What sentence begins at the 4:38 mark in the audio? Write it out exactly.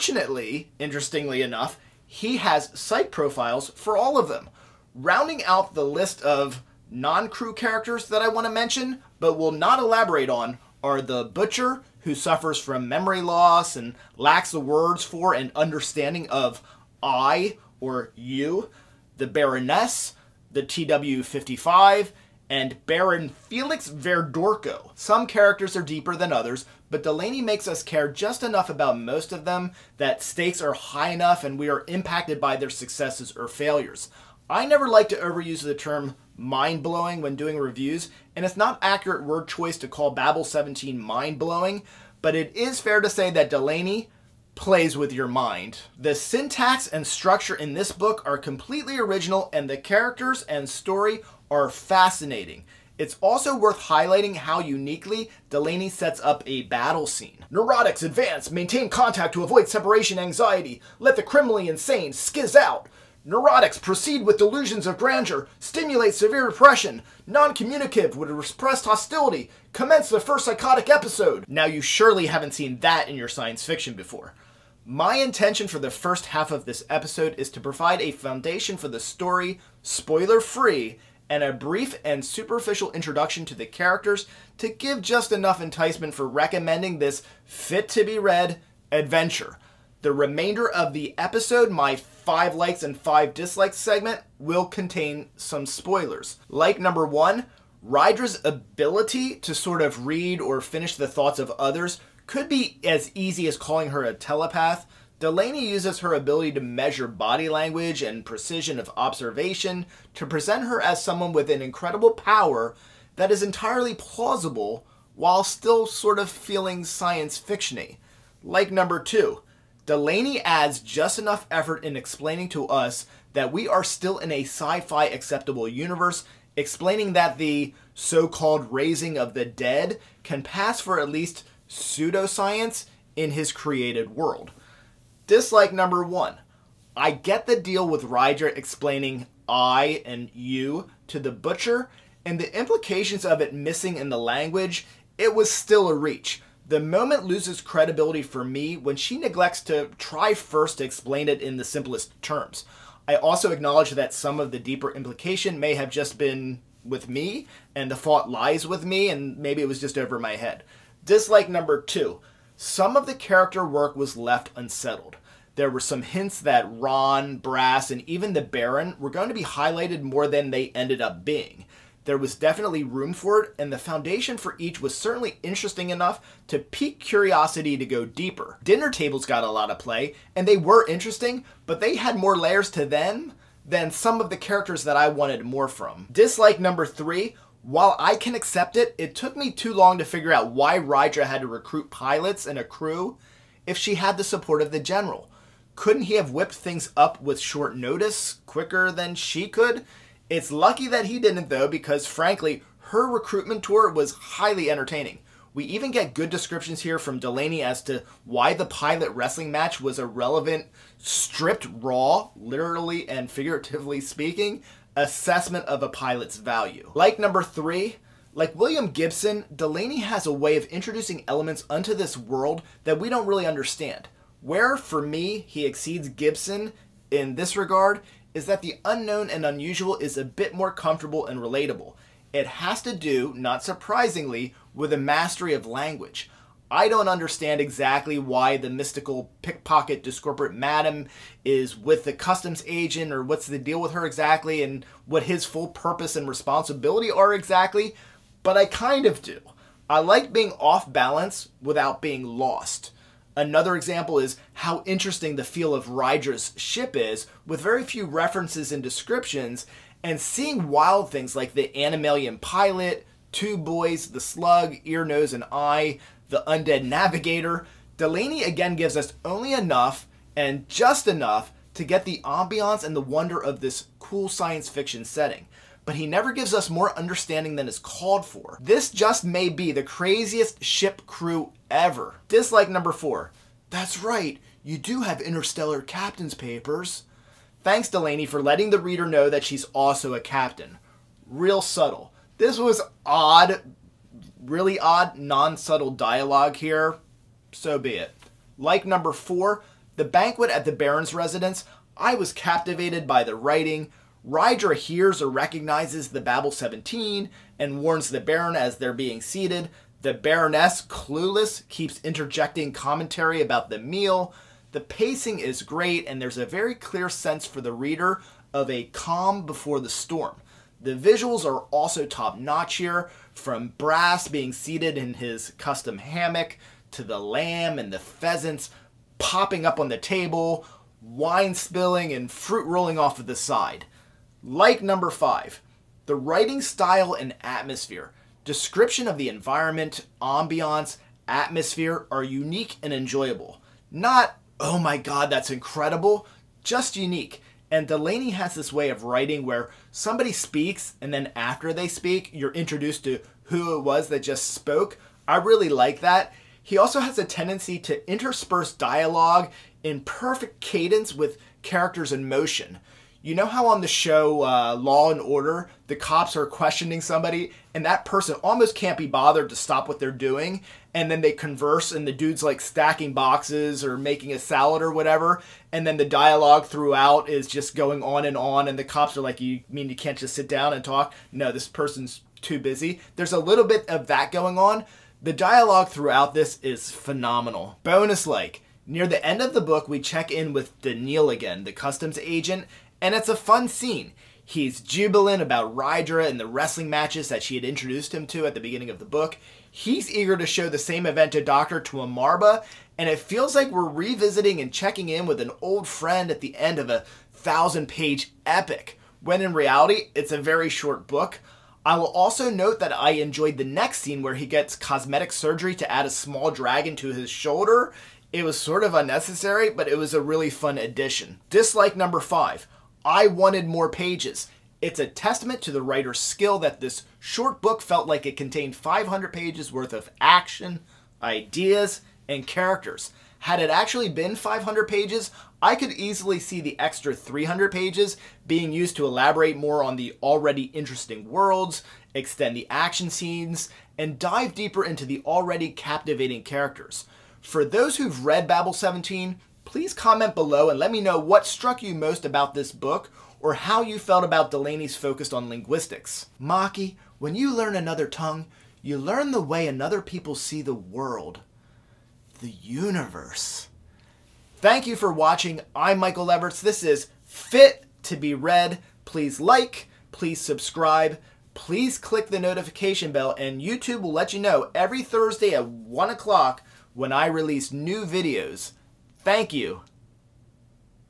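This just may be the craziest ship crew ever.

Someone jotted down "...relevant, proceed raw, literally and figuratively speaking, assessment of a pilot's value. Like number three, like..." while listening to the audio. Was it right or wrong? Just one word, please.
wrong.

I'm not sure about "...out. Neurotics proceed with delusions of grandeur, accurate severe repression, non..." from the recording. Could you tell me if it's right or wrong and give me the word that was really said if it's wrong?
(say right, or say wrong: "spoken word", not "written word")
wrong: "stimulate", not "accurate".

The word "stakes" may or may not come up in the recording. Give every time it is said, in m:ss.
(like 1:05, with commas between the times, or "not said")
0:30.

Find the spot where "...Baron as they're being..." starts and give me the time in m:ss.
5:08.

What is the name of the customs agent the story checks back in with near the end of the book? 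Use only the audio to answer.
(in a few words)
Daniel.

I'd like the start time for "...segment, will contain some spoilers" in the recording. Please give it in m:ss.
1:33.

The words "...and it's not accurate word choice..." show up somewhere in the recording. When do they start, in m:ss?
0:38.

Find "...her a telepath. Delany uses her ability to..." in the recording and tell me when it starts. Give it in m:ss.
1:43.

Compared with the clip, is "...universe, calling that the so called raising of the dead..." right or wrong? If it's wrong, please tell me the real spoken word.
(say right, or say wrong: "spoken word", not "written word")
wrong: "explaining", not "calling".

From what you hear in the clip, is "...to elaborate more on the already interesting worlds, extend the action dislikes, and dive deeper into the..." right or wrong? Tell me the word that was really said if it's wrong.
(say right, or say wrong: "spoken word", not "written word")
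wrong: "scenes", not "dislikes".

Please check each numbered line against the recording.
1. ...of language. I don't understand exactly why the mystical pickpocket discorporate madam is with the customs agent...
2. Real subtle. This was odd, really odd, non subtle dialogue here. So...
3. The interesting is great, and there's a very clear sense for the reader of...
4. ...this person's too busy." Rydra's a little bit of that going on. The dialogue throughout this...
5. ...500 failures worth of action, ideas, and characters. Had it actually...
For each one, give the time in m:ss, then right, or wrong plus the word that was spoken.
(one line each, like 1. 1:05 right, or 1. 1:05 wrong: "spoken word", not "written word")
1. 3:55 right
2. 4:51 right
3. 5:14 wrong: "pacing", not "interesting"
4. 6:21 wrong: "There", not "Rydra"
5. 7:08 wrong: "pages", not "failures".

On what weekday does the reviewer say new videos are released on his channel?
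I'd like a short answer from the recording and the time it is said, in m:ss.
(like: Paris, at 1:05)
Thursday, at 7:55.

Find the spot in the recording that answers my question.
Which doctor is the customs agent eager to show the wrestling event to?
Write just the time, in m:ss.
6:41.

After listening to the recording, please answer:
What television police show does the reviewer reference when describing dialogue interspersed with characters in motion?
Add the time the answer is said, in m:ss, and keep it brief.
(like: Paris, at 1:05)
Law and Order, at 6:04.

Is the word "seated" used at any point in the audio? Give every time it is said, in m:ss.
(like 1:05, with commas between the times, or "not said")
5:09, 5:24.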